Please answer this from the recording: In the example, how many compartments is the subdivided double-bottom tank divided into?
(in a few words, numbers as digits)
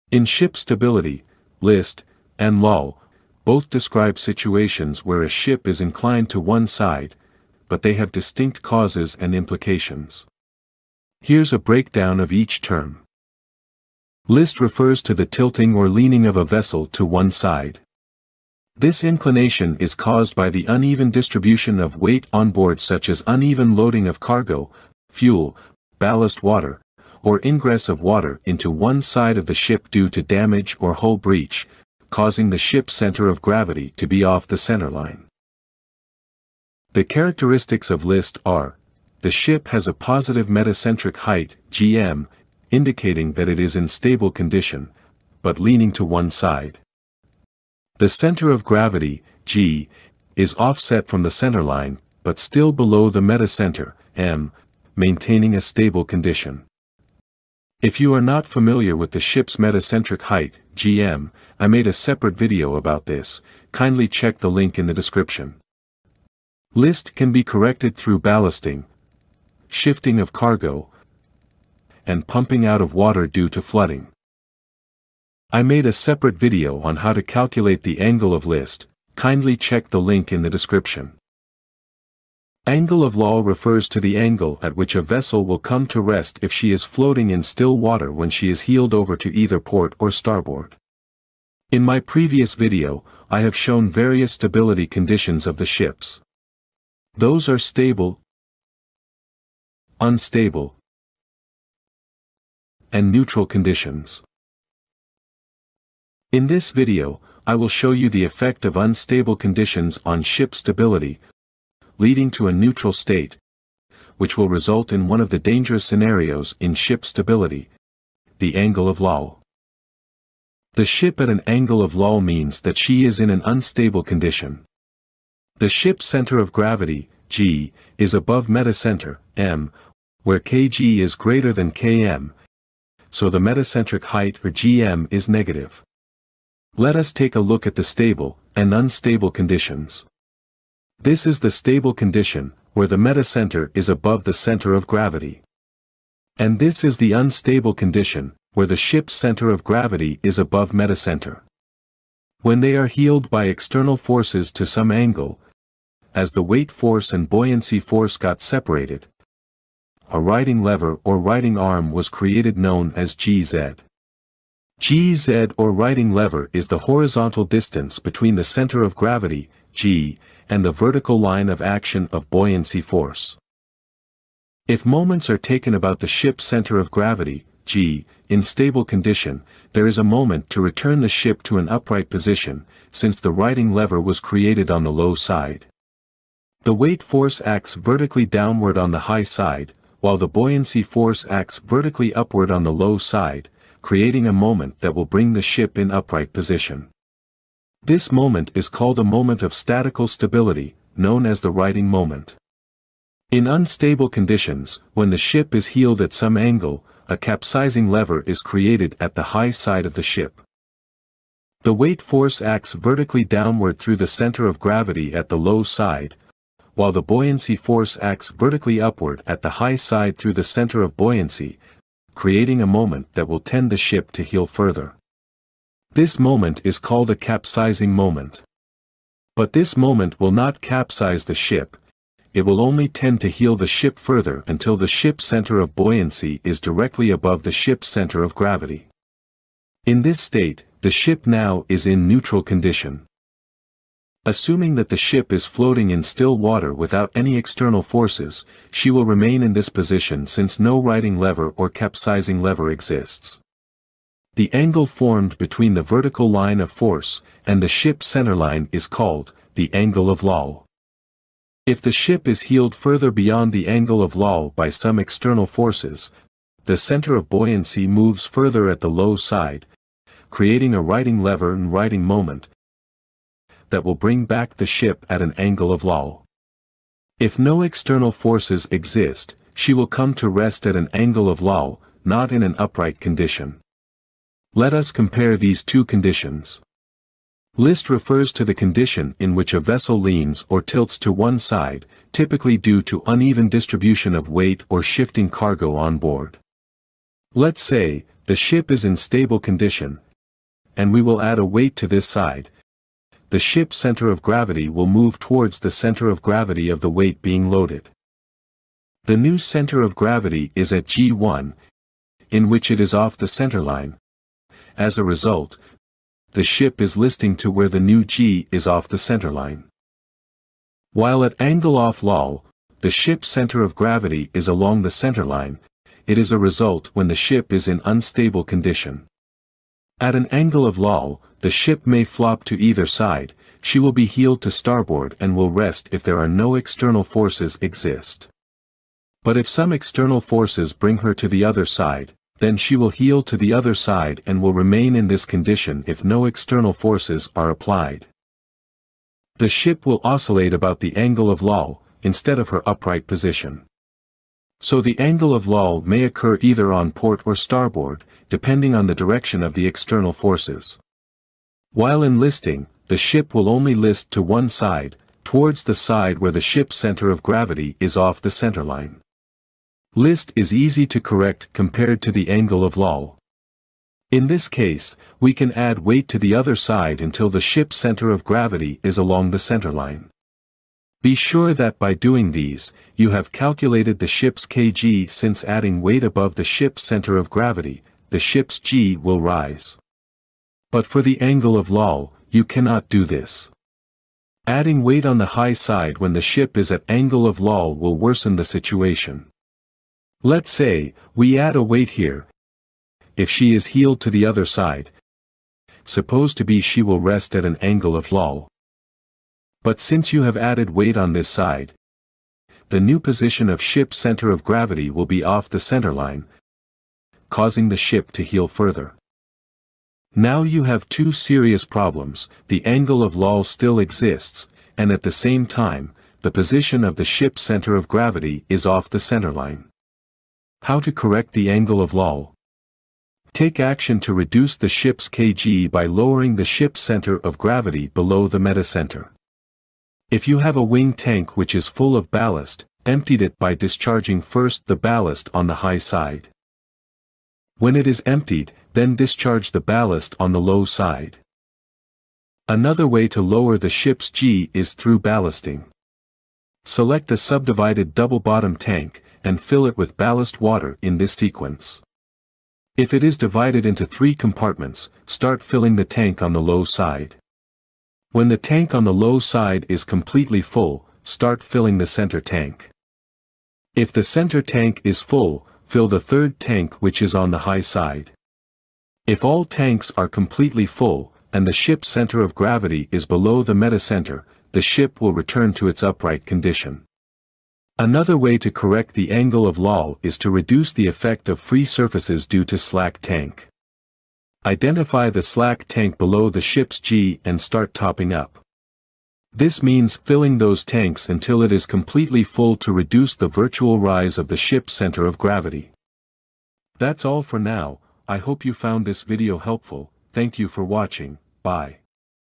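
3.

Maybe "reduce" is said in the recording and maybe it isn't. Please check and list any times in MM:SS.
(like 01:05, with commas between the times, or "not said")
07:14, 08:10, 08:22.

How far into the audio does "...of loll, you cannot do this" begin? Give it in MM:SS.
06:31.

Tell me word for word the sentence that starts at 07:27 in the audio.
When it is emptied, then discharge the ballast on the low side.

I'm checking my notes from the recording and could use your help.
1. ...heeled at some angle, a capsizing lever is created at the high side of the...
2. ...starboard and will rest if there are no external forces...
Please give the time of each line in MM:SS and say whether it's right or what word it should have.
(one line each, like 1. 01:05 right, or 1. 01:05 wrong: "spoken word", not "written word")
1. 03:25 right
2. 05:34 right.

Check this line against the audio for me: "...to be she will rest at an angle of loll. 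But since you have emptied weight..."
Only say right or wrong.
wrong.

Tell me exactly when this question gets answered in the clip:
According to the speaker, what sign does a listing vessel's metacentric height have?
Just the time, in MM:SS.
00:39.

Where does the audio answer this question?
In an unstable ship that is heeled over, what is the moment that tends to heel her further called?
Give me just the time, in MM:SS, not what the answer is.
03:47.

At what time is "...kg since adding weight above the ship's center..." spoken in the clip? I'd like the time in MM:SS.
06:24.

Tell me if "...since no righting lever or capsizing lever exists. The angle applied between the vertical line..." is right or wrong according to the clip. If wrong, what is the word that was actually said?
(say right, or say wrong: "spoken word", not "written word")
wrong: "formed", not "applied".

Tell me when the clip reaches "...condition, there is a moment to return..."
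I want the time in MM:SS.
02:58.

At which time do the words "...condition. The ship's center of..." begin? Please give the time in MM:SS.
02:04.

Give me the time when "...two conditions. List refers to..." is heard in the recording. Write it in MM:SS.
04:45.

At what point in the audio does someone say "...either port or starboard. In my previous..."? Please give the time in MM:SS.
01:29.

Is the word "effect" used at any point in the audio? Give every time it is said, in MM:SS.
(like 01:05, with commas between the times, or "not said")
01:48, 08:10.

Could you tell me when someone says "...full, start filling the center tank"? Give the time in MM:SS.
07:50.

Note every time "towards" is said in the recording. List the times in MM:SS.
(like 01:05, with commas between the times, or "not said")
05:05, 06:05.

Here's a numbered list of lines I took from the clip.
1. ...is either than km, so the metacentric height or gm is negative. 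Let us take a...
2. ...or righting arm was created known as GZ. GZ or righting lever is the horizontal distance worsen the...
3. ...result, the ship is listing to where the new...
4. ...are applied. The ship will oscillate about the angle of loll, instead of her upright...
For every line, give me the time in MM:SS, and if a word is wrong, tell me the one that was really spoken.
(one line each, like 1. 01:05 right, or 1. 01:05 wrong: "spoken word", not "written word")
1. 02:10 wrong: "greater", not "either"
2. 02:41 wrong: "between", not "worsen"
3. 05:15 right
4. 05:47 right.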